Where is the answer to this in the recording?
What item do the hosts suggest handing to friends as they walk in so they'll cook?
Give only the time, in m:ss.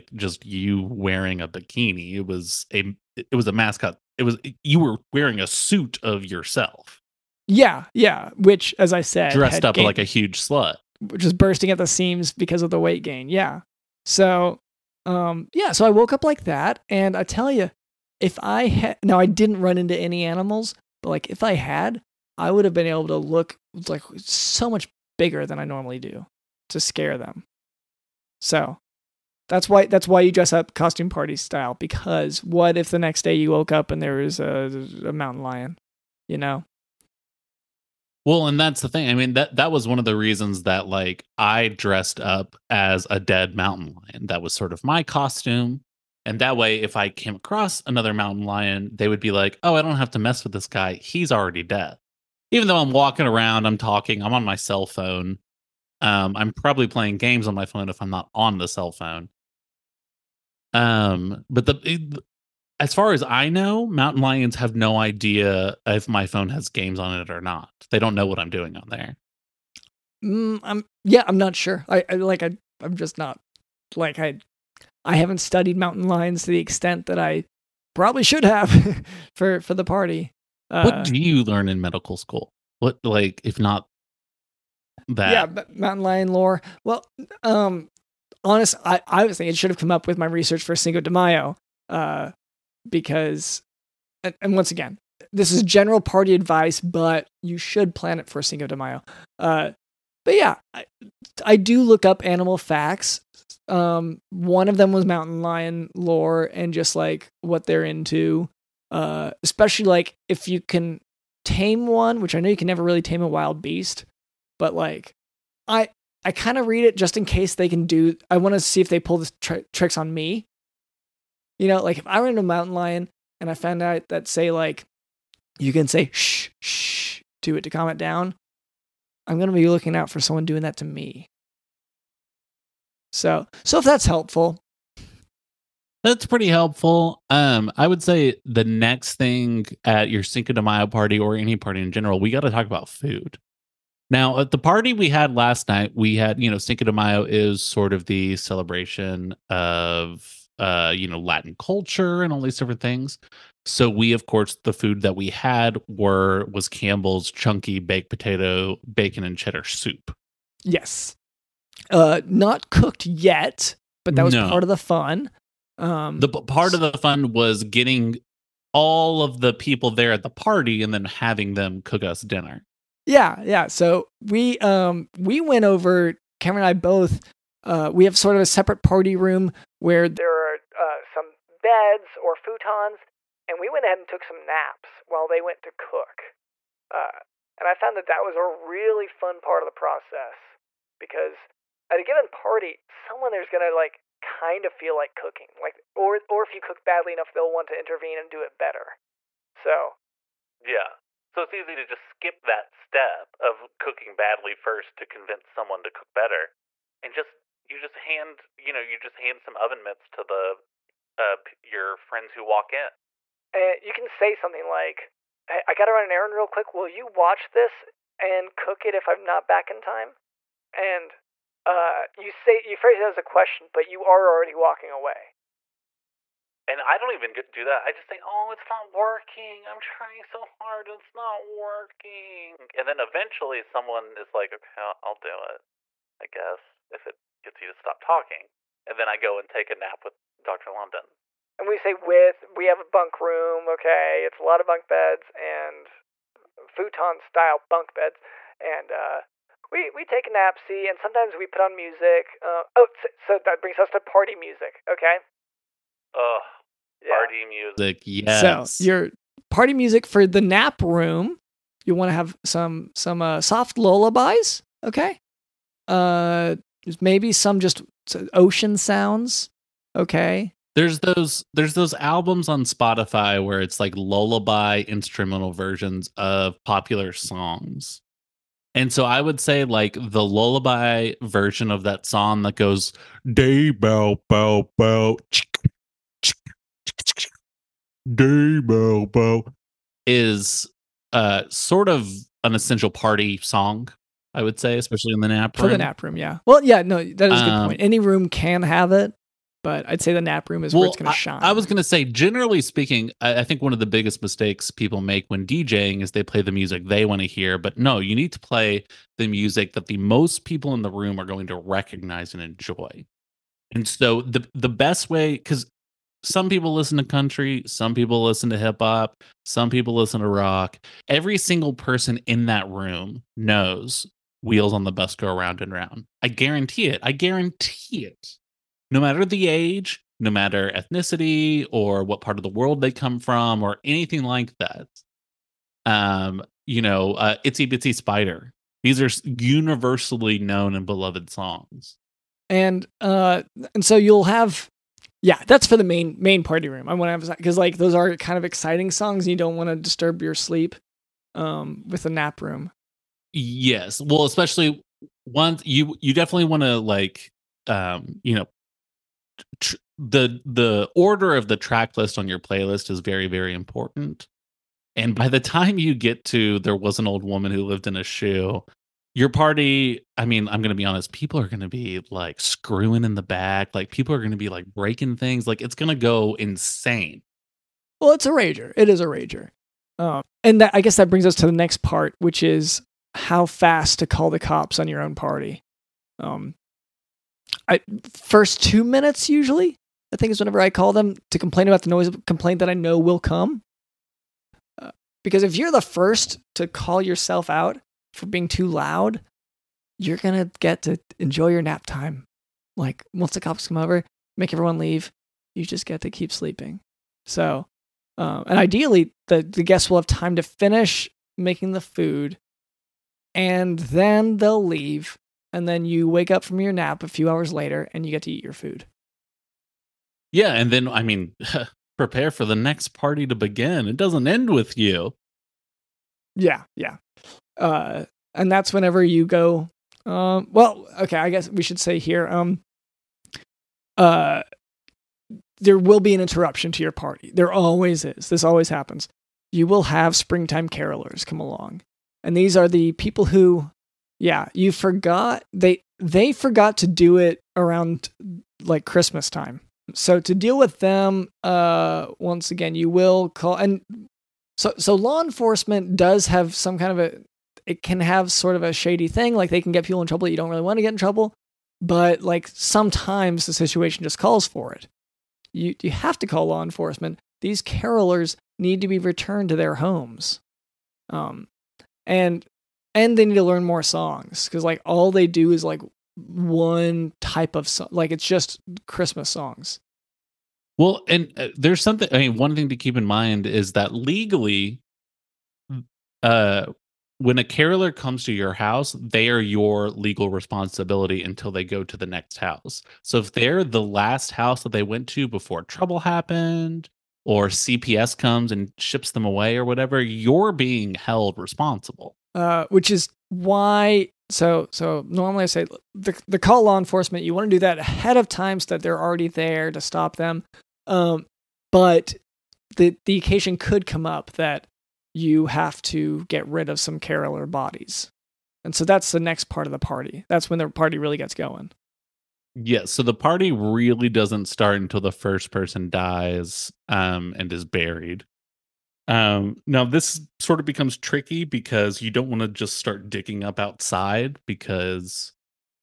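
3:29.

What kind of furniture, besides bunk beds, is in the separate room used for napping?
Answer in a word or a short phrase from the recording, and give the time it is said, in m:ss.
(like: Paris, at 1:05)
Futons, at 3:02.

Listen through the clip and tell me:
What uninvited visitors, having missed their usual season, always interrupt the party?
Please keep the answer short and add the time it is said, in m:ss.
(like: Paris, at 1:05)
Springtime carolers, at 7:20.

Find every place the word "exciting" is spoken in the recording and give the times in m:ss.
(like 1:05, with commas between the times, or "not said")
5:48.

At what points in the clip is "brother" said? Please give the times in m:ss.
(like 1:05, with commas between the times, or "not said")
not said.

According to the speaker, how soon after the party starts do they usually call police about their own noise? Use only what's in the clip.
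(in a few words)
First 2 minutes.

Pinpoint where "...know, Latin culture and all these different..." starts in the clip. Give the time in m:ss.
2:31.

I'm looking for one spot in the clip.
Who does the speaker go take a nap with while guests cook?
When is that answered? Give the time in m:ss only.
4:00.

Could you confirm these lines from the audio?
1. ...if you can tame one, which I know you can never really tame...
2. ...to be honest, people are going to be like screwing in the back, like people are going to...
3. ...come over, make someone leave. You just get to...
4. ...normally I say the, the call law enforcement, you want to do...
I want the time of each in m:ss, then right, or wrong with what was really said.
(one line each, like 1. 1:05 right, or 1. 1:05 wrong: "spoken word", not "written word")
1. 1:50 right
2. 6:10 right
3. 6:43 wrong: "everyone", not "someone"
4. 8:25 right.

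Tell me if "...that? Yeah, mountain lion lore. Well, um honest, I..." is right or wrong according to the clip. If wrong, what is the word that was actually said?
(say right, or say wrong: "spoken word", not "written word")
right.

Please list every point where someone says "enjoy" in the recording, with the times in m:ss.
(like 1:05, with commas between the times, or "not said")
5:12, 6:41.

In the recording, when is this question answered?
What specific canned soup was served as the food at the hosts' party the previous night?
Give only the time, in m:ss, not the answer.
2:36.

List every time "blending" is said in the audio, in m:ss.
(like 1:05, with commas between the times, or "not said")
not said.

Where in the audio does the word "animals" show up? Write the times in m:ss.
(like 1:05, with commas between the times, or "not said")
0:20, 1:42.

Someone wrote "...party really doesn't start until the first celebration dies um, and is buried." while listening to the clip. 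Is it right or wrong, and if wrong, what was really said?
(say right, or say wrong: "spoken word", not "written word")
wrong: "person", not "celebration".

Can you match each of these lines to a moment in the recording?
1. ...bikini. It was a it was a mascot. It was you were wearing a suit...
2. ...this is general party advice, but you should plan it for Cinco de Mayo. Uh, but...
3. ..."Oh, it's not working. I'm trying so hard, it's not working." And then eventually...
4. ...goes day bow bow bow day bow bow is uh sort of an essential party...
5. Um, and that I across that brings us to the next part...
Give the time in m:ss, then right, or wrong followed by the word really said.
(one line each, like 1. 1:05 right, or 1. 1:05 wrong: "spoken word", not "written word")
1. 0:01 right
2. 1:35 right
3. 3:48 right
4. 4:42 right
5. 6:19 wrong: "guess", not "across".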